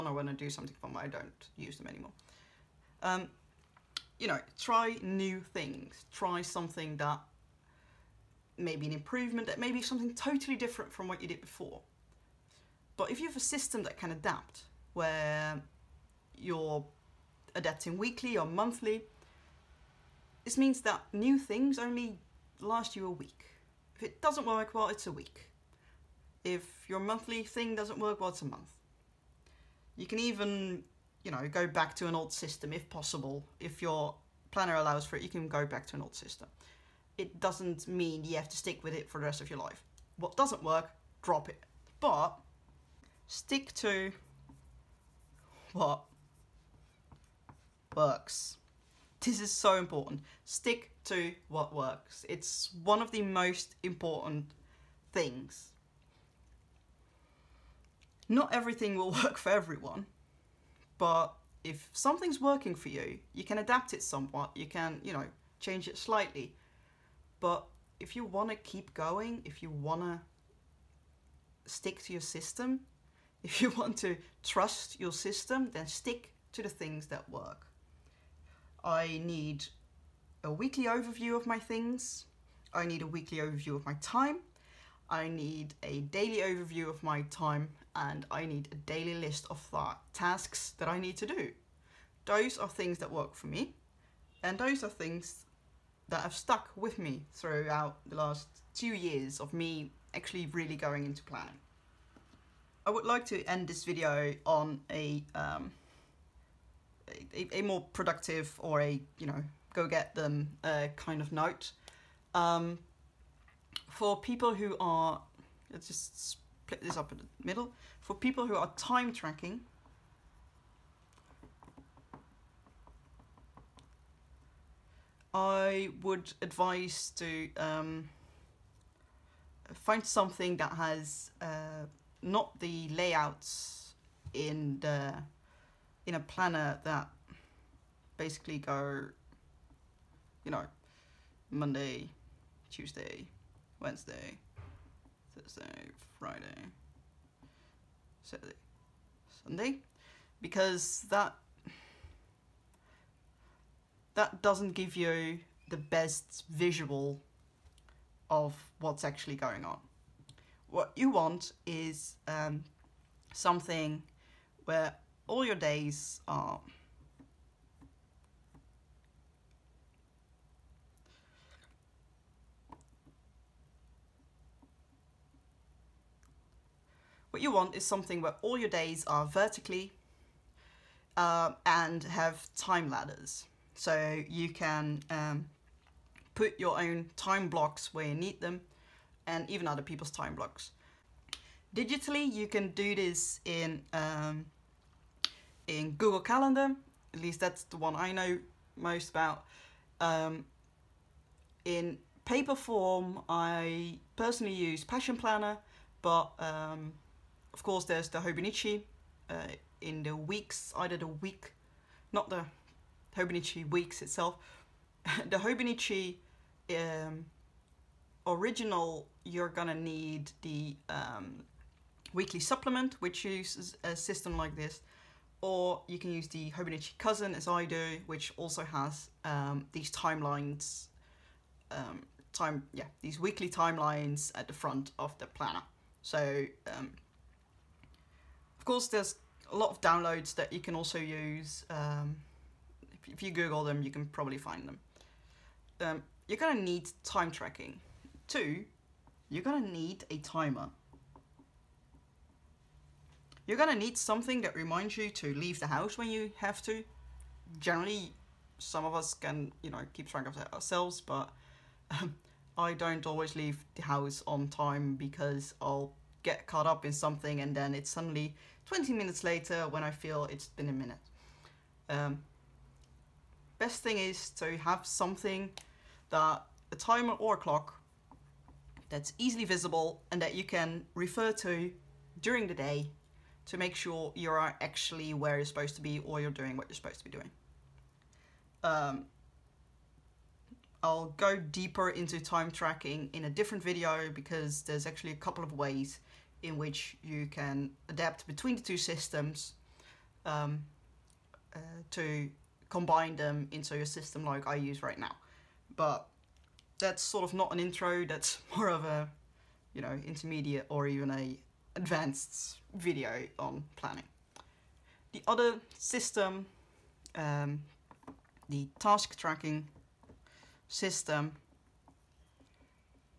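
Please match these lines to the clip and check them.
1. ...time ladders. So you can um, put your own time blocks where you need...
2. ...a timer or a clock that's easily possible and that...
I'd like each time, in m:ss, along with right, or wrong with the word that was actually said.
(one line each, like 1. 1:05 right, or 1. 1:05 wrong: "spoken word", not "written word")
1. 3:02 right
2. 4:36 wrong: "visible", not "possible".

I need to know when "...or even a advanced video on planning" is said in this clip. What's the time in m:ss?
5:10.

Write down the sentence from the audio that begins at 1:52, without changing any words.
Um, for people who are, let's just split this up in the middle.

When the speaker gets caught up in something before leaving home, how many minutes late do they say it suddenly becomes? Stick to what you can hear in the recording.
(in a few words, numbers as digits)
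20 minutes.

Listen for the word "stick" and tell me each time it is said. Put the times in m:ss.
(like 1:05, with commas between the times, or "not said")
0:38, 0:43, 0:50, 1:11, 1:15.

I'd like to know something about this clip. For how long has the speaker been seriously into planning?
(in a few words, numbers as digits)
2 years.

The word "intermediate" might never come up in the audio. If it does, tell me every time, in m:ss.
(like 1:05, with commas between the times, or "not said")
5:10.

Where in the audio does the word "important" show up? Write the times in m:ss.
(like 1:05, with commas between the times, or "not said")
0:49, 0:53.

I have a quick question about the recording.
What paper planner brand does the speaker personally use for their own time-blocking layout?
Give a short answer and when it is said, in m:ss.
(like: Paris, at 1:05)
Passion Planner, at 3:24.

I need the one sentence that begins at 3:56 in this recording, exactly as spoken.
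So um, of course there's a lot of downloads that you can also use.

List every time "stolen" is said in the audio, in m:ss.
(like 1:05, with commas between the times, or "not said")
not said.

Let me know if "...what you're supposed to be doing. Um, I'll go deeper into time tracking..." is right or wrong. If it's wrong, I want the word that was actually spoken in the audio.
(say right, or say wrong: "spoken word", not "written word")
right.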